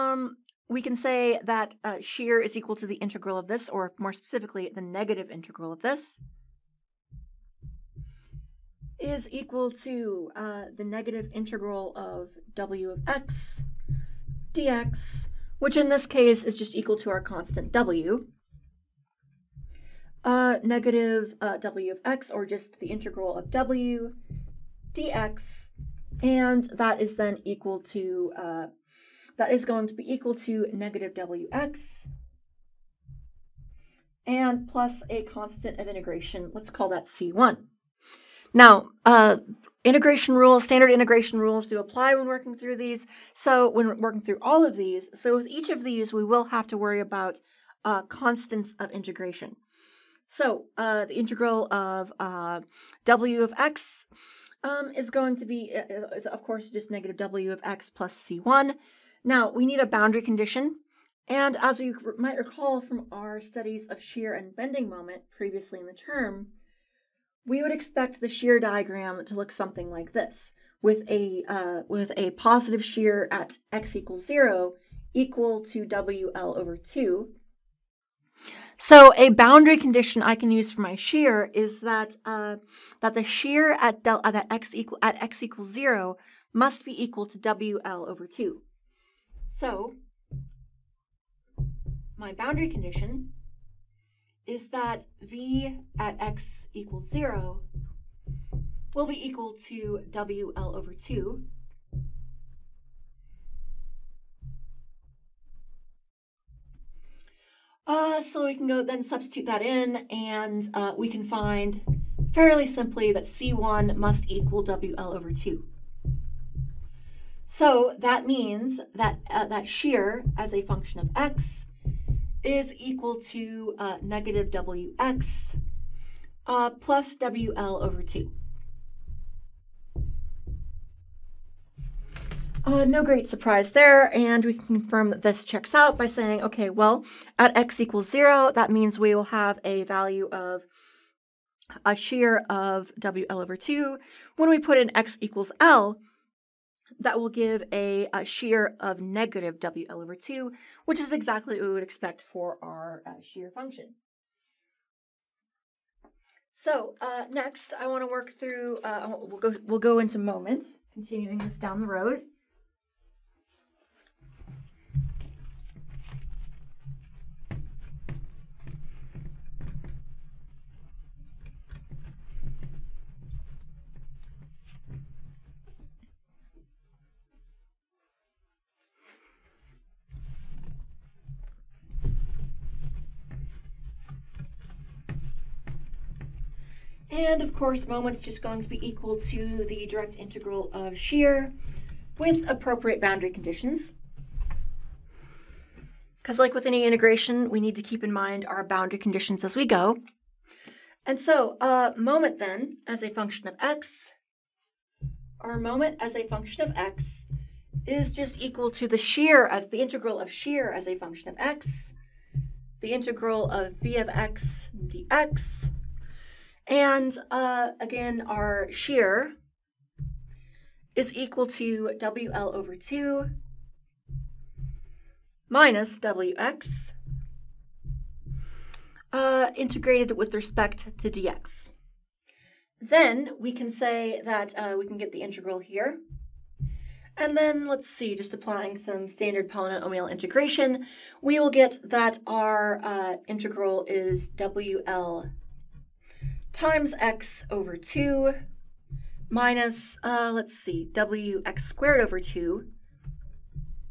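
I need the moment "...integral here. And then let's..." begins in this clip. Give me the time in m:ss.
3:55.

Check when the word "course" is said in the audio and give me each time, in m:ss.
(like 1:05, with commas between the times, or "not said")
0:56, 3:07.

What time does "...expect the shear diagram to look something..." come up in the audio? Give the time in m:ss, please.
1:07.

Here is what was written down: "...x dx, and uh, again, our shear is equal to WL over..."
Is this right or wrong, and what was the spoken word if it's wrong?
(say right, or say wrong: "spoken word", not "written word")
right.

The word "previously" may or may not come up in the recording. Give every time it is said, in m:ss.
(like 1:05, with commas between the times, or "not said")
1:05.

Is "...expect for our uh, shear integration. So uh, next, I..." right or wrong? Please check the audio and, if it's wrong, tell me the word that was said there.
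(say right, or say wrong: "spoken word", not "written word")
wrong: "function", not "integration".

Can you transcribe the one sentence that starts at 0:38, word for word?
Now, uh, integration rules, standard integration rules do apply when working through these.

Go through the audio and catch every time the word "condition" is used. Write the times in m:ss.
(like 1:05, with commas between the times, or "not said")
1:00, 1:19, 1:32, 3:13, 3:18.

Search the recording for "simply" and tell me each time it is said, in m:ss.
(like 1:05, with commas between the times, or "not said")
1:52.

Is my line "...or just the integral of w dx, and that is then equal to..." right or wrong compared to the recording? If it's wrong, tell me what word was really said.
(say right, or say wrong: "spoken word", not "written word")
right.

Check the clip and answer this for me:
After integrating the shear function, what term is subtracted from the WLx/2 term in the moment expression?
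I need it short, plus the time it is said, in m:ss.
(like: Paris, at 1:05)
wx²/2, at 4:10.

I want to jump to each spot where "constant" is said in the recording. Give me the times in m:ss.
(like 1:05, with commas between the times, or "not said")
0:17, 0:35, 0:48.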